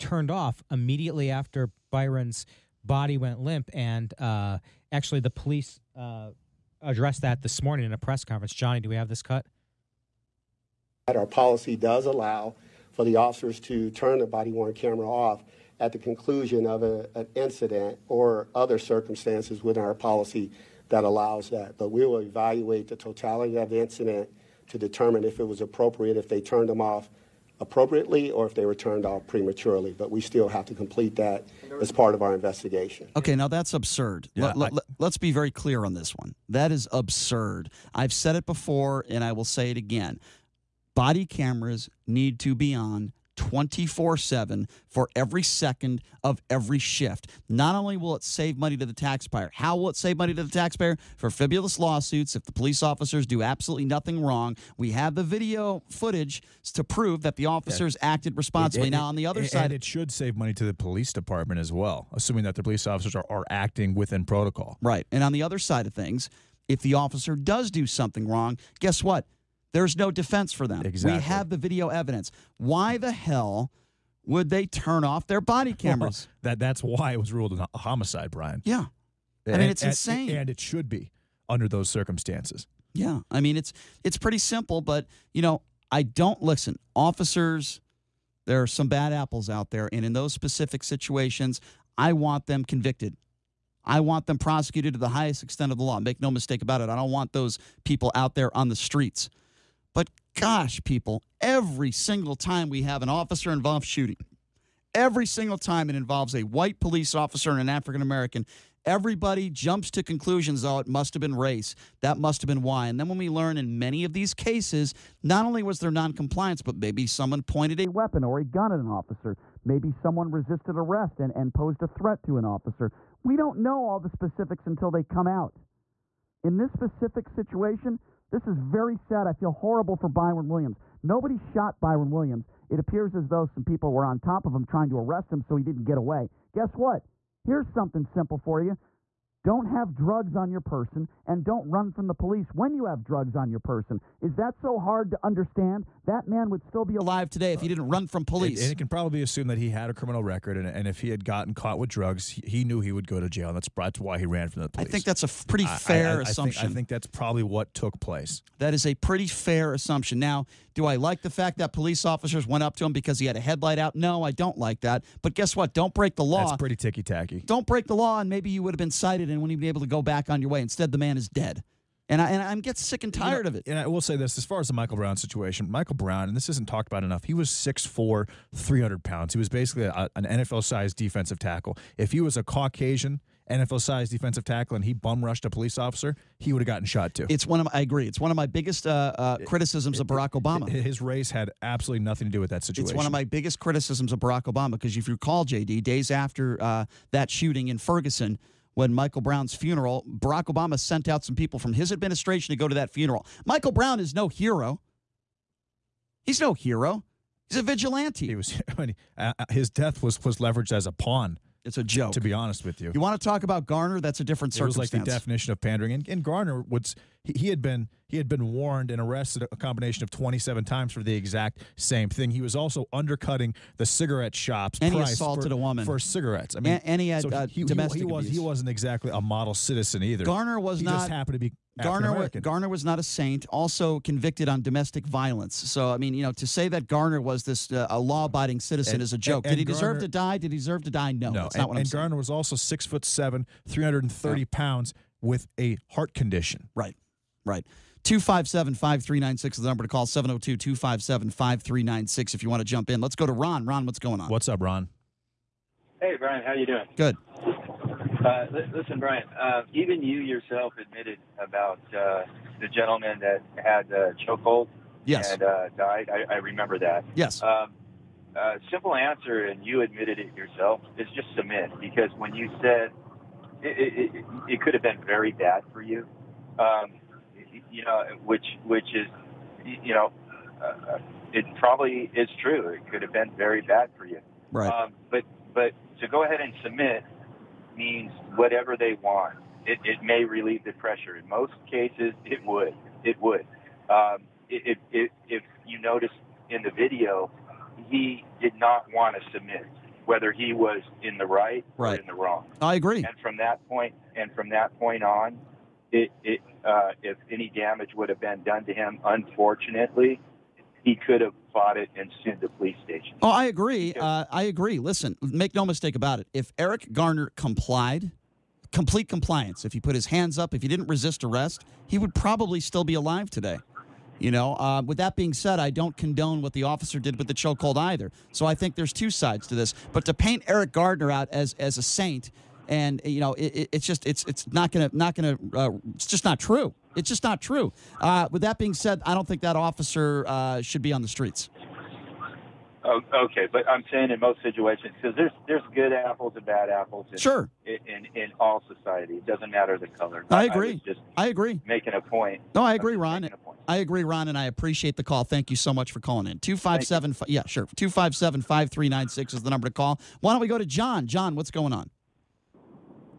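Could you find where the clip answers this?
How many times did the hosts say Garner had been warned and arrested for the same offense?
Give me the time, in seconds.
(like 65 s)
220 s.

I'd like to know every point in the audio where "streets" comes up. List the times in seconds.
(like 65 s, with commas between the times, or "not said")
98 s, 341 s.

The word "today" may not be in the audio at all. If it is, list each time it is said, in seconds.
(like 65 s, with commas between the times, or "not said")
147 s, 323 s.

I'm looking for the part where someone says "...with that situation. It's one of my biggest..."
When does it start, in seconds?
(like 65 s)
192 s.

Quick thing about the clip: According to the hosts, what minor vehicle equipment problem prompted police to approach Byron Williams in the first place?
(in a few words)
headlight out.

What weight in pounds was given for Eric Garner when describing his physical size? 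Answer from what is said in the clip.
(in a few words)
330.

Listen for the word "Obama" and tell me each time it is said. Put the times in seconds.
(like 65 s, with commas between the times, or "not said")
190 s, 194 s, 200 s.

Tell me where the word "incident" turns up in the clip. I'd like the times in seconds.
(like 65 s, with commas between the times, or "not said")
17 s, 23 s.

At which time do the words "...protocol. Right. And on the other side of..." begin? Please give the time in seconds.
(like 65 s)
64 s.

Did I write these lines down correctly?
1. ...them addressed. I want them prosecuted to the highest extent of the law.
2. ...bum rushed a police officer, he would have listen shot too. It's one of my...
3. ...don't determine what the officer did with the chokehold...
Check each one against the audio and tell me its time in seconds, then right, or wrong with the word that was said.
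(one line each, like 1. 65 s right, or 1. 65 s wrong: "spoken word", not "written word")
1. 92 s wrong: "convicted", not "addressed"
2. 184 s wrong: "gotten", not "listen"
3. 325 s wrong: "condone", not "determine".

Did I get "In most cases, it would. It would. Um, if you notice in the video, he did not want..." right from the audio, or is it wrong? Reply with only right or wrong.
right.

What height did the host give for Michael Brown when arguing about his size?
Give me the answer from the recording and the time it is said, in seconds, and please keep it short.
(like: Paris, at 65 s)
6'4, at 177 s.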